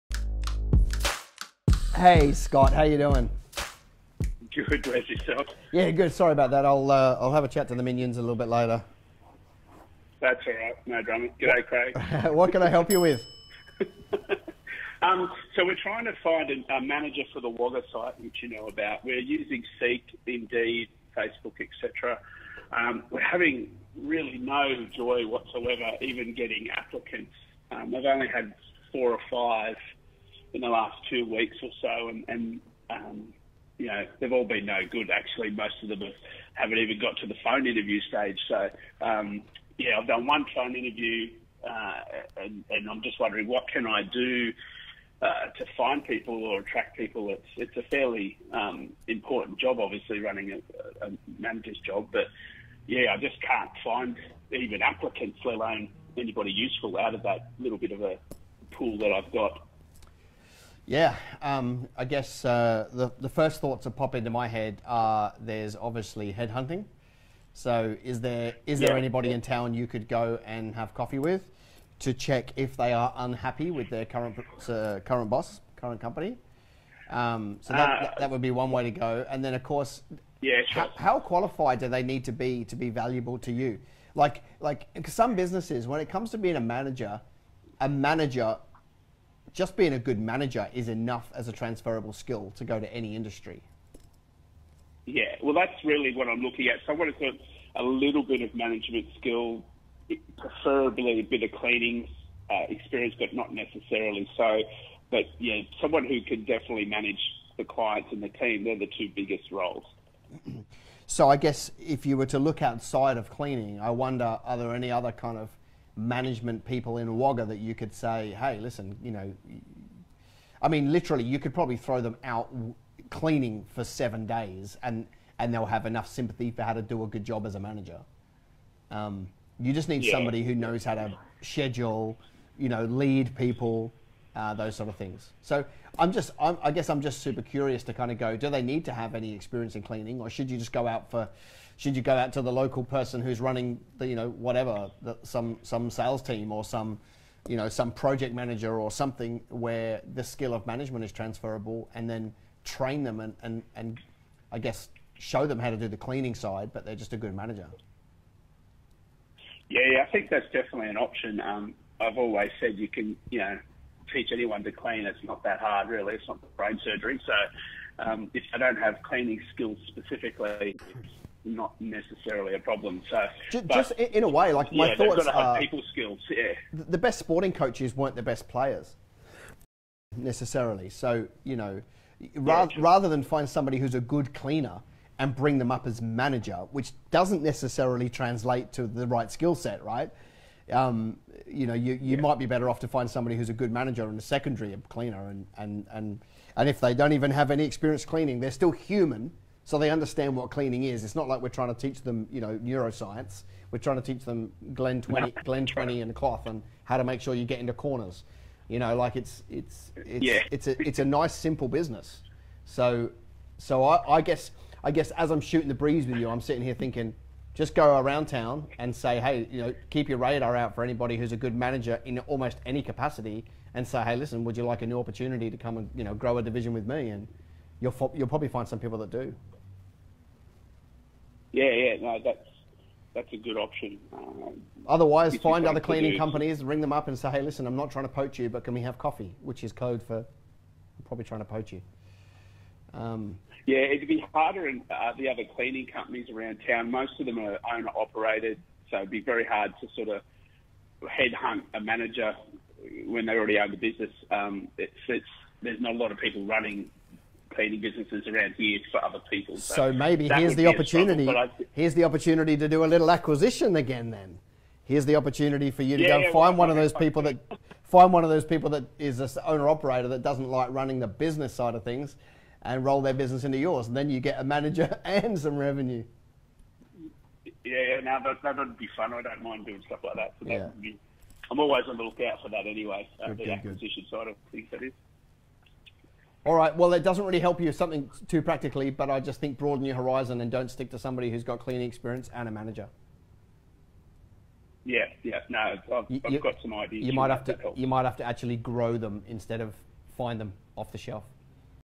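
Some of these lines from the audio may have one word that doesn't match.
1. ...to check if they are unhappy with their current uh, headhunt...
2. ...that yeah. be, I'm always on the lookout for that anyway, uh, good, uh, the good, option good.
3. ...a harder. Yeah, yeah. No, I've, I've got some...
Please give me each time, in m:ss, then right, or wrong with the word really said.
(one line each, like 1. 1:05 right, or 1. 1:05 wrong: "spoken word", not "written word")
1. 1:11 wrong: "current", not "headhunt"
2. 4:40 wrong: "acquisition", not "option"
3. 4:52 wrong: "manager", not "harder".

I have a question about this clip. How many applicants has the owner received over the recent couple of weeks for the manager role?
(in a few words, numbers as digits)
4 or 5.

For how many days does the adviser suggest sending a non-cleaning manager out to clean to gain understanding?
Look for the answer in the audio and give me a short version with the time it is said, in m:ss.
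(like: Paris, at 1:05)
7, at 2:03.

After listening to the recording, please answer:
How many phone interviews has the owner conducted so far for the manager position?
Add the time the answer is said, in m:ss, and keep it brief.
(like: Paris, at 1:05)
1, at 0:40.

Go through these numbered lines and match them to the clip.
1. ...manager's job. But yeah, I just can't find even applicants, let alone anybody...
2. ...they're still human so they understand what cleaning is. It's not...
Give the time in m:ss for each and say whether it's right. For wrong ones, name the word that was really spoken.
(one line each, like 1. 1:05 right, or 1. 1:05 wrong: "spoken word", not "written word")
1. 0:51 right
2. 3:18 right.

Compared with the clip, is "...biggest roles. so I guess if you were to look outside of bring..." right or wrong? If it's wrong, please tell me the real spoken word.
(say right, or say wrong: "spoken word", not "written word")
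wrong: "cleaning", not "bring".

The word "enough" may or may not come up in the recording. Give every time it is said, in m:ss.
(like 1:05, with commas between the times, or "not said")
1:30, 2:05.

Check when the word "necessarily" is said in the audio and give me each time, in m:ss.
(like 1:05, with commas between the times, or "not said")
1:43, 2:51, 3:00, 3:07.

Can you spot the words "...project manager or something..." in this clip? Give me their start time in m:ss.
2:27.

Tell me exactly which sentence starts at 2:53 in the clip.
So just, but, just in a way, like my yeah, thoughts got are people skills.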